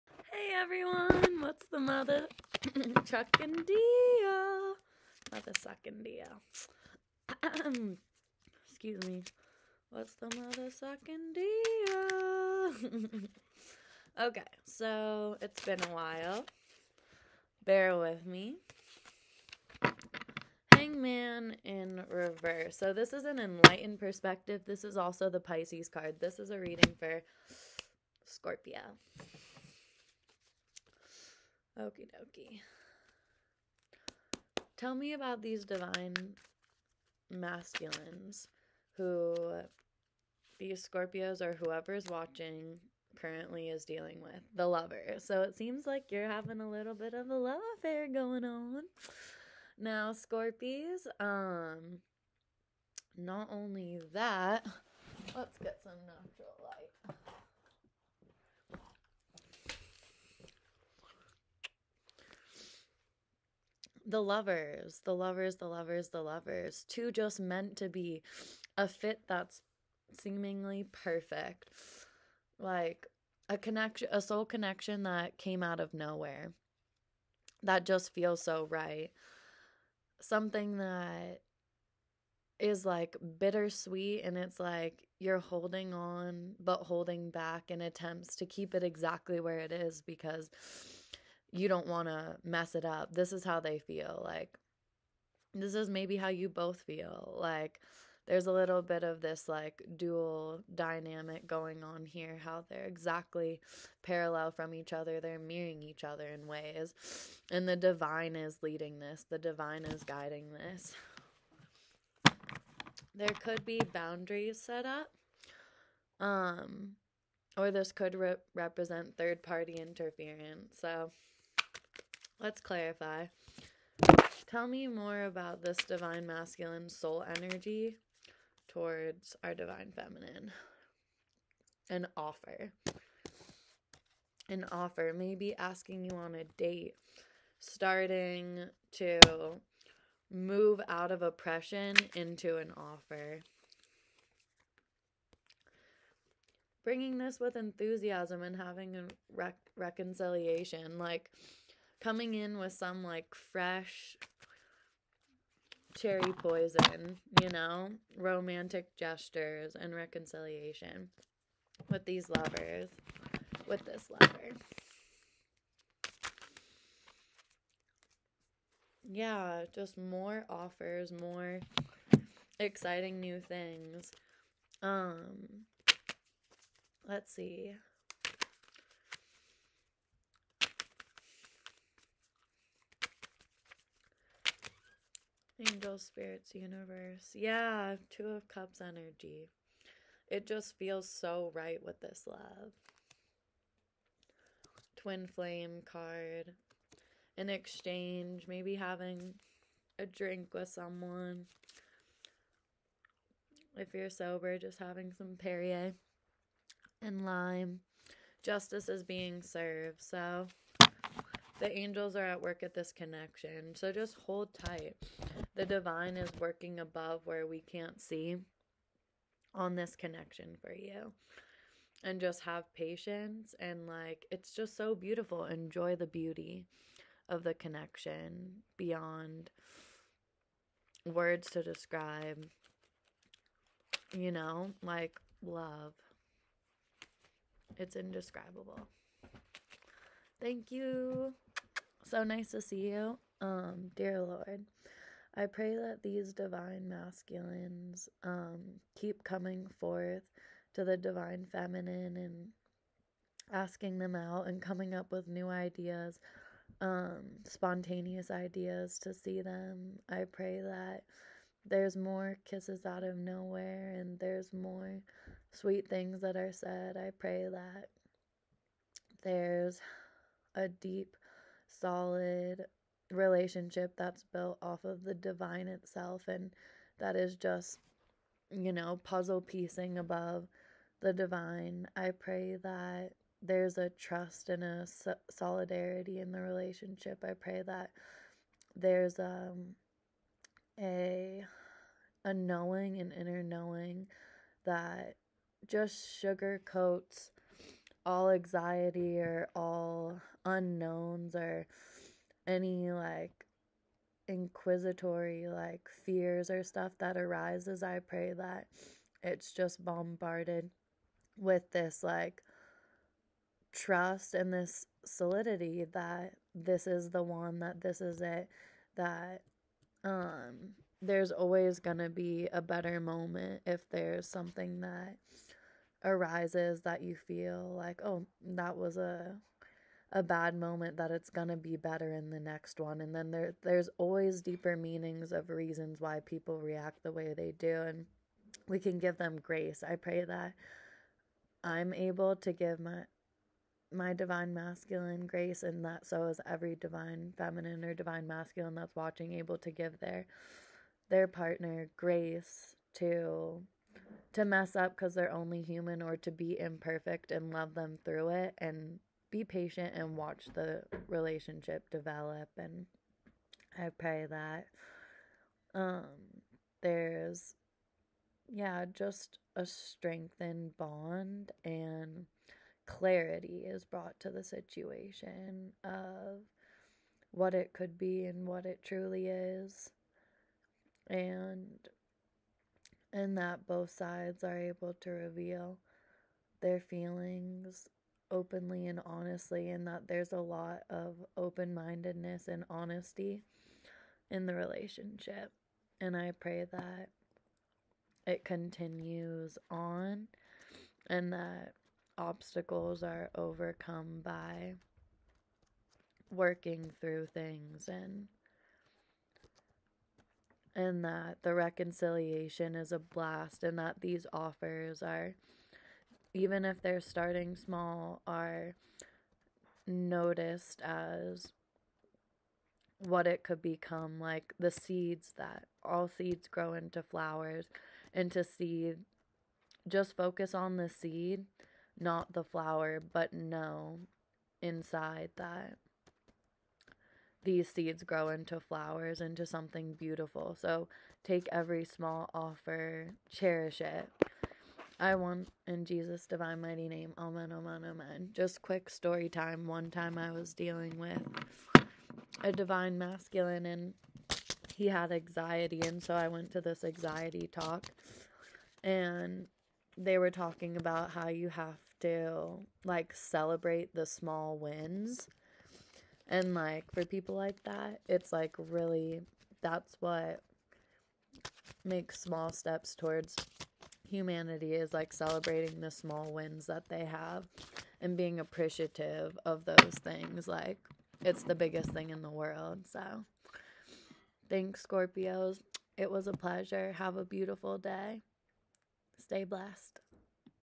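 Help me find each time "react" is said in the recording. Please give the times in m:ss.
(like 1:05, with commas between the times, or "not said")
5:36.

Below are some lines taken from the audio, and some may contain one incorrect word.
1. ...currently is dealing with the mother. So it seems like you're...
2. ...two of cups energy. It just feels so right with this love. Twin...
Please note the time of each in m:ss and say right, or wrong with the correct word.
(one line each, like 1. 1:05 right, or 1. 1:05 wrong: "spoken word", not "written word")
1. 0:43 wrong: "lover", not "mother"
2. 3:08 right.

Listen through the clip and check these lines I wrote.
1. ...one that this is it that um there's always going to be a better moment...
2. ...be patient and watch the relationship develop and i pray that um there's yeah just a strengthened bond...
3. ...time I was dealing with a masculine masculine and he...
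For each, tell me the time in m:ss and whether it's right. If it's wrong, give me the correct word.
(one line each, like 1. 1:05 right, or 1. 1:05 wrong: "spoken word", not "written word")
1. 5:17 right
2. 5:59 right
3. 7:29 wrong: "divine", not "masculine".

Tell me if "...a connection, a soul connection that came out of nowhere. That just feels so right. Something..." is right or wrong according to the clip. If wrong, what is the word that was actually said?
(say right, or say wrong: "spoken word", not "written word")
right.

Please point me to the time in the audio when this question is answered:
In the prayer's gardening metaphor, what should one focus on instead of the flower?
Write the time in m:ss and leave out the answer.
7:10.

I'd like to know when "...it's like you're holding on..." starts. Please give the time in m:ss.
1:24.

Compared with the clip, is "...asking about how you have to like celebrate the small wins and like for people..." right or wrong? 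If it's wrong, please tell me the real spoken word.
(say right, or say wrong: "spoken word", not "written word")
wrong: "talking", not "asking".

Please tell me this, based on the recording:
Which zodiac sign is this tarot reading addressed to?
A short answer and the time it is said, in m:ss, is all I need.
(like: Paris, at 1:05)
Scorpio, at 0:28.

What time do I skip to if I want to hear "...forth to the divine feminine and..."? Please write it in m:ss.
4:09.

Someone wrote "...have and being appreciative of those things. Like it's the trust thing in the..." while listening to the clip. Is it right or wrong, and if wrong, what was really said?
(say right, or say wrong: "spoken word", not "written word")
wrong: "biggest", not "trust".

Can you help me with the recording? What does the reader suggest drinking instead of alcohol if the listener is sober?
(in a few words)
Perrier and lime.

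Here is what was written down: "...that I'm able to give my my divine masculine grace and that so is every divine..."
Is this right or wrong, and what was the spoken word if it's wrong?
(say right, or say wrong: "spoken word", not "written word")
right.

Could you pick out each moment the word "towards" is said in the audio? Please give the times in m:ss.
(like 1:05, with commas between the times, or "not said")
2:08, 7:52.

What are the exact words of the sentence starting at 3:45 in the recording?
Enjoy the beauty of the connection beyond words to describe.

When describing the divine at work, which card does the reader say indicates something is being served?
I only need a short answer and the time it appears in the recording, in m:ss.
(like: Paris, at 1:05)
Justice, at 3:28.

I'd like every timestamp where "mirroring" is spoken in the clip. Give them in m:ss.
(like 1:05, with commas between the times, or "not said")
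1:45.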